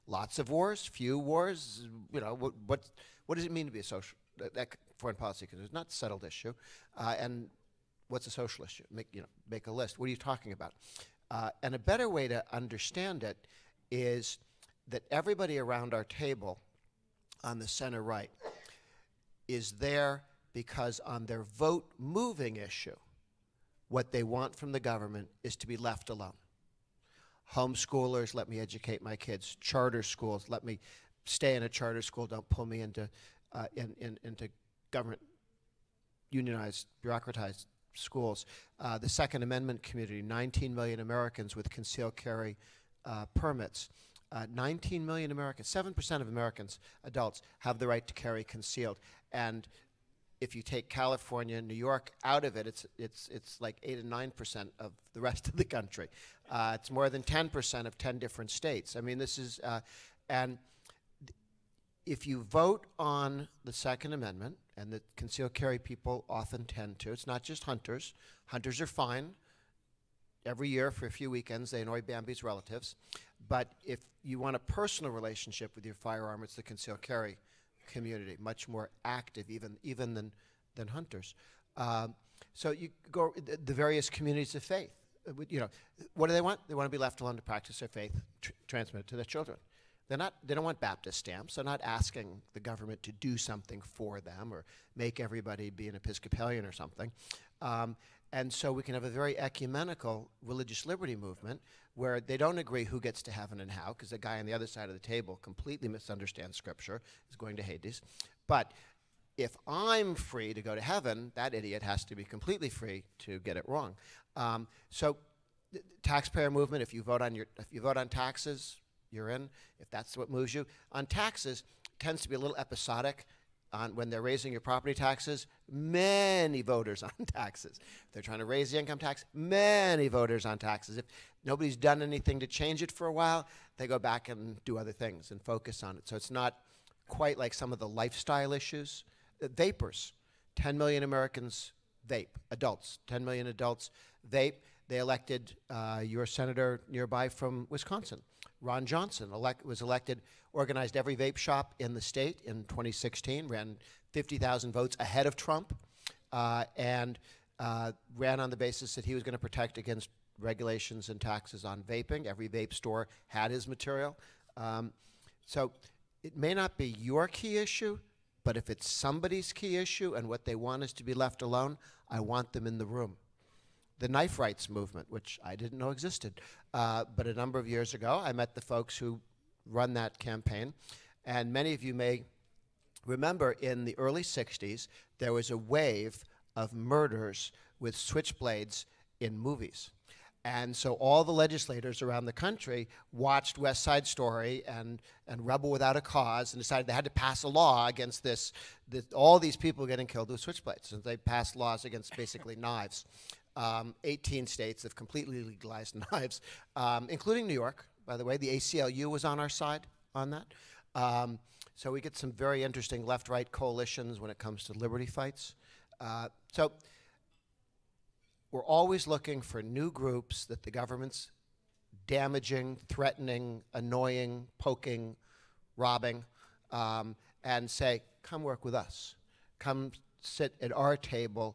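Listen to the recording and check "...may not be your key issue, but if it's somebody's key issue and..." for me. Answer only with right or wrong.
right.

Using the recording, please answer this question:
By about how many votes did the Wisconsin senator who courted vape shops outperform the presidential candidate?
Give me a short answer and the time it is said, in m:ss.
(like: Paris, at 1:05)
50,000, at 2:34.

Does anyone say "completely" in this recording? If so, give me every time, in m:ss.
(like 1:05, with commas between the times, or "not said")
1:45, 1:52, 3:24.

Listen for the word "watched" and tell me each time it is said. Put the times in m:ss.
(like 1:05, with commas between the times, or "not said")
3:13.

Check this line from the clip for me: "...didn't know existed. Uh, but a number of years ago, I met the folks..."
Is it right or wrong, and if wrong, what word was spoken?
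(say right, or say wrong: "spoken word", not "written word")
right.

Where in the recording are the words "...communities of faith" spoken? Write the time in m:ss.
1:24.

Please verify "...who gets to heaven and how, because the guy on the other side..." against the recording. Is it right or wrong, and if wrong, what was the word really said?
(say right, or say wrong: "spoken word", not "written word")
right.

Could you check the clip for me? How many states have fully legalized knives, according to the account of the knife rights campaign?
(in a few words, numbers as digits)
18.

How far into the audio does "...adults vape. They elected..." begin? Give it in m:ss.
2:23.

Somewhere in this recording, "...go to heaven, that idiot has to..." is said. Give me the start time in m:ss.
1:50.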